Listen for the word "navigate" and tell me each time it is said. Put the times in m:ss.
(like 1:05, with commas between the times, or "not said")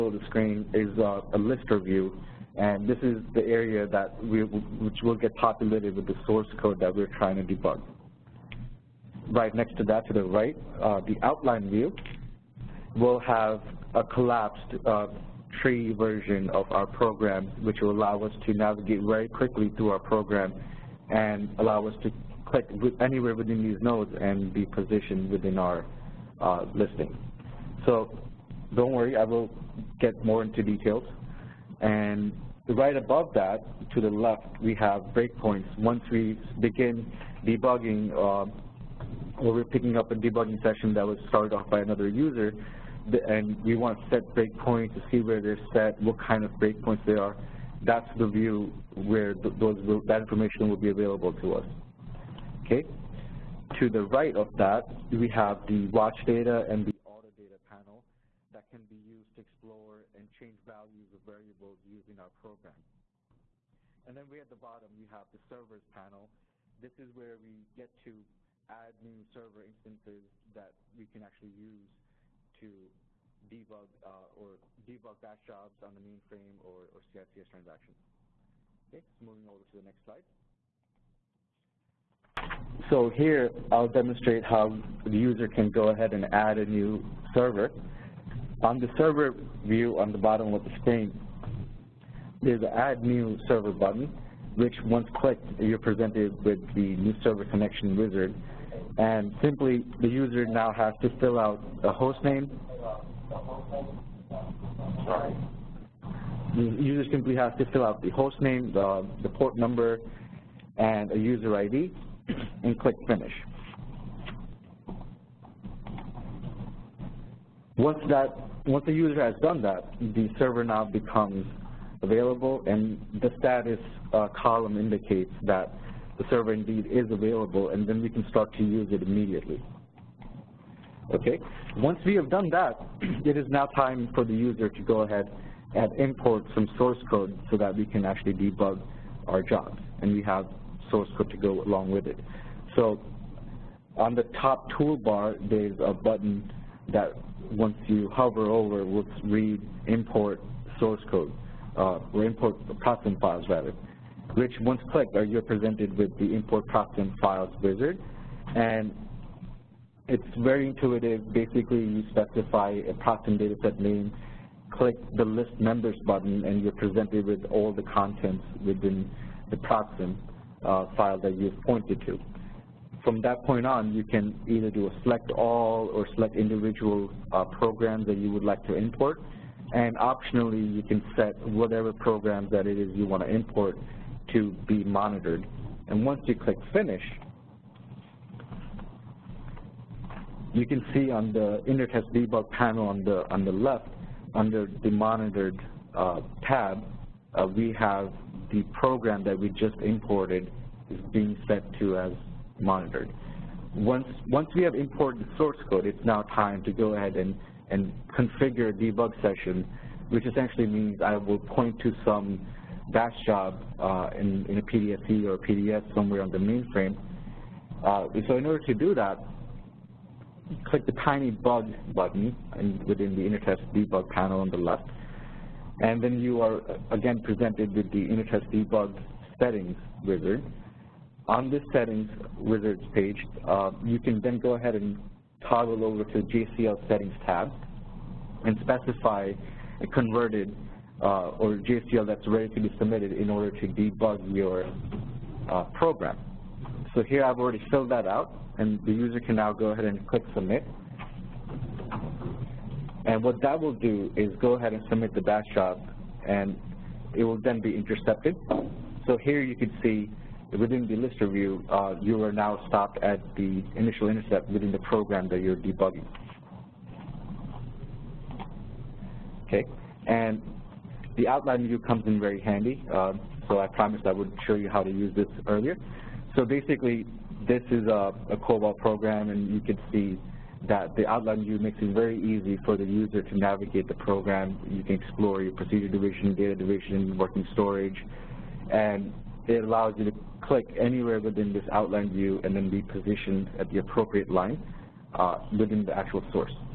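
0:18, 4:43.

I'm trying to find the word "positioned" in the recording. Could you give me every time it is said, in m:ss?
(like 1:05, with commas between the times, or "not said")
0:24, 4:52.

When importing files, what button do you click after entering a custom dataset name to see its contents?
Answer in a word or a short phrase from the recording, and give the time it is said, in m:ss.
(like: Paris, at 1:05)
list members, at 2:45.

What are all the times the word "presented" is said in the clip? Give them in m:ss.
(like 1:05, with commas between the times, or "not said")
1:35, 2:35, 2:46, 3:47.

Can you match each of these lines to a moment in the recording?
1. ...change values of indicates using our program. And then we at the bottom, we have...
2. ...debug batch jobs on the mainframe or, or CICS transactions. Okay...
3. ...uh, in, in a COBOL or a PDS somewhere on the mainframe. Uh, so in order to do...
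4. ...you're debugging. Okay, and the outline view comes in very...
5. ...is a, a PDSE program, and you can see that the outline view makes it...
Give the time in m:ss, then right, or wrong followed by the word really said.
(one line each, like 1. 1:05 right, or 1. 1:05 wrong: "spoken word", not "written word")
1. 1:00 wrong: "variables", not "indicates"
2. 1:14 right
3. 3:33 wrong: "PDSE", not "COBOL"
4. 4:25 right
5. 4:37 wrong: "COBOL", not "PDSE".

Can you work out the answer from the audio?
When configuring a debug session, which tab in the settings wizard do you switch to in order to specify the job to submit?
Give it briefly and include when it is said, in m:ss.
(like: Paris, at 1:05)
JCL settings, at 3:56.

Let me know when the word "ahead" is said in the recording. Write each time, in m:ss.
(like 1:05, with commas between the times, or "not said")
1:25, 2:15, 3:26, 3:54, 4:09, 4:14.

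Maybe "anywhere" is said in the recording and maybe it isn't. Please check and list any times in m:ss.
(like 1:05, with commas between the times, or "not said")
0:22, 4:50.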